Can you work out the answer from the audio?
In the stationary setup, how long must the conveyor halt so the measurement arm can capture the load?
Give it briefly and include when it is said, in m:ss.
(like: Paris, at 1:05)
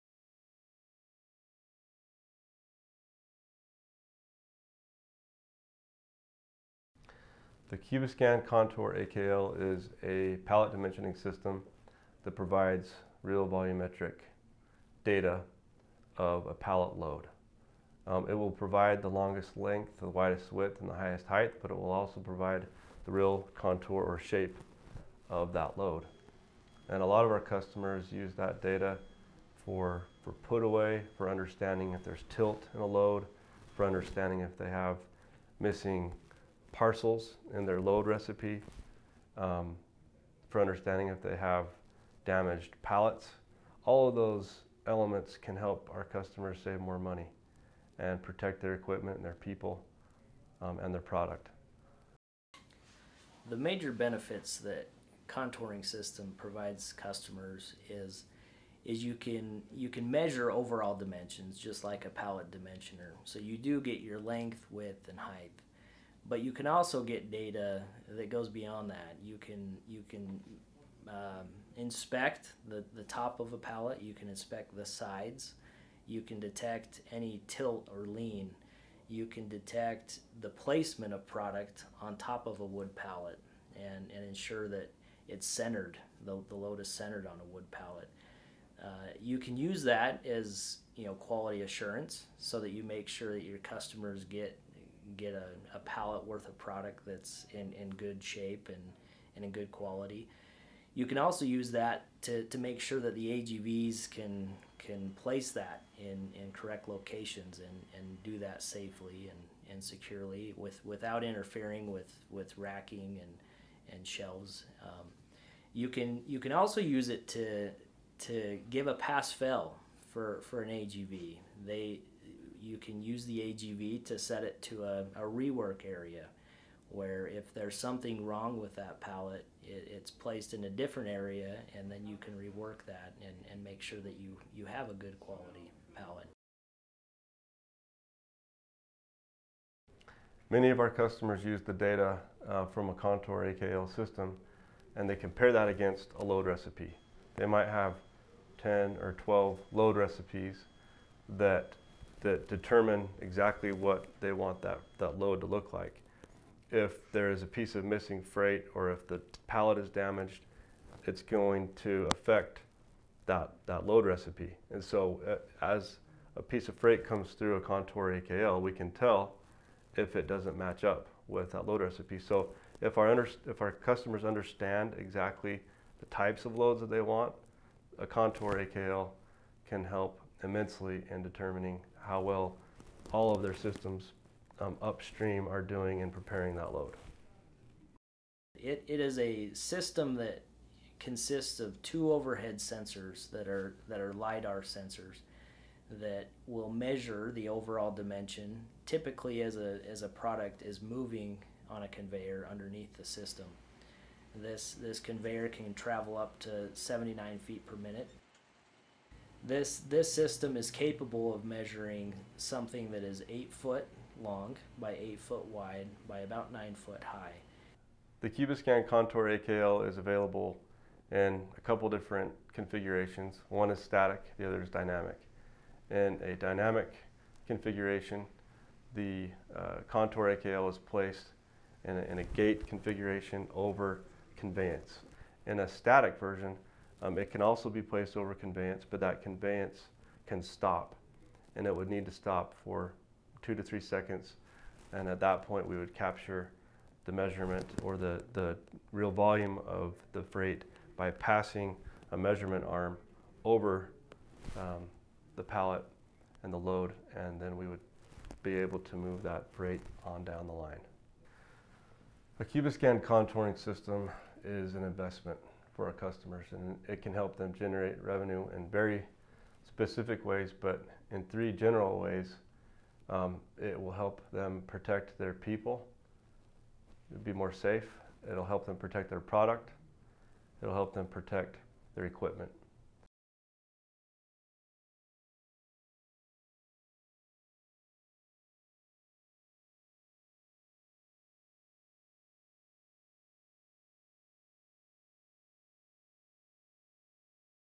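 2 to 3 seconds, at 4:03.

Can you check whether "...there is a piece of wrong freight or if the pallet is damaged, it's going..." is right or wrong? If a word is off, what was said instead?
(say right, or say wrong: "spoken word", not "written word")
wrong: "missing", not "wrong".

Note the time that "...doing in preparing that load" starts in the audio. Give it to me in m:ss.
3:05.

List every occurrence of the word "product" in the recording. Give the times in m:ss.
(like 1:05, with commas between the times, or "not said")
0:51, 1:21, 1:36, 3:20, 4:39.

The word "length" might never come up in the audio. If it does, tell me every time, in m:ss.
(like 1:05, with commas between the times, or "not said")
0:19, 1:04.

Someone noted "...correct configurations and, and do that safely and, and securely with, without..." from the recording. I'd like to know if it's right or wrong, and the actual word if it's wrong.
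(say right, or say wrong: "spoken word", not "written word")
wrong: "locations", not "configurations".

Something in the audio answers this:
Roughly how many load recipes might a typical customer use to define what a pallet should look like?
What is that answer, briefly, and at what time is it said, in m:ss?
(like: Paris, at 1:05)
10 or 12, at 2:28.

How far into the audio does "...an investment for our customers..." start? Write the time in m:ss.
4:24.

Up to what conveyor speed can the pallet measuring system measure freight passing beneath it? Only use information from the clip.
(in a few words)
79 feet per minute.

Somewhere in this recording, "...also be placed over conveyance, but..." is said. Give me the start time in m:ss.
3:57.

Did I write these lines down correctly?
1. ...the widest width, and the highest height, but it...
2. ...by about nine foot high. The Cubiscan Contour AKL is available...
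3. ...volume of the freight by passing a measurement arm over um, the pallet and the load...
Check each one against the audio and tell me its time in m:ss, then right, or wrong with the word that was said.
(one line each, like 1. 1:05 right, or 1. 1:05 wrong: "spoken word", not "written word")
1. 0:20 right
2. 3:36 right
3. 4:09 right.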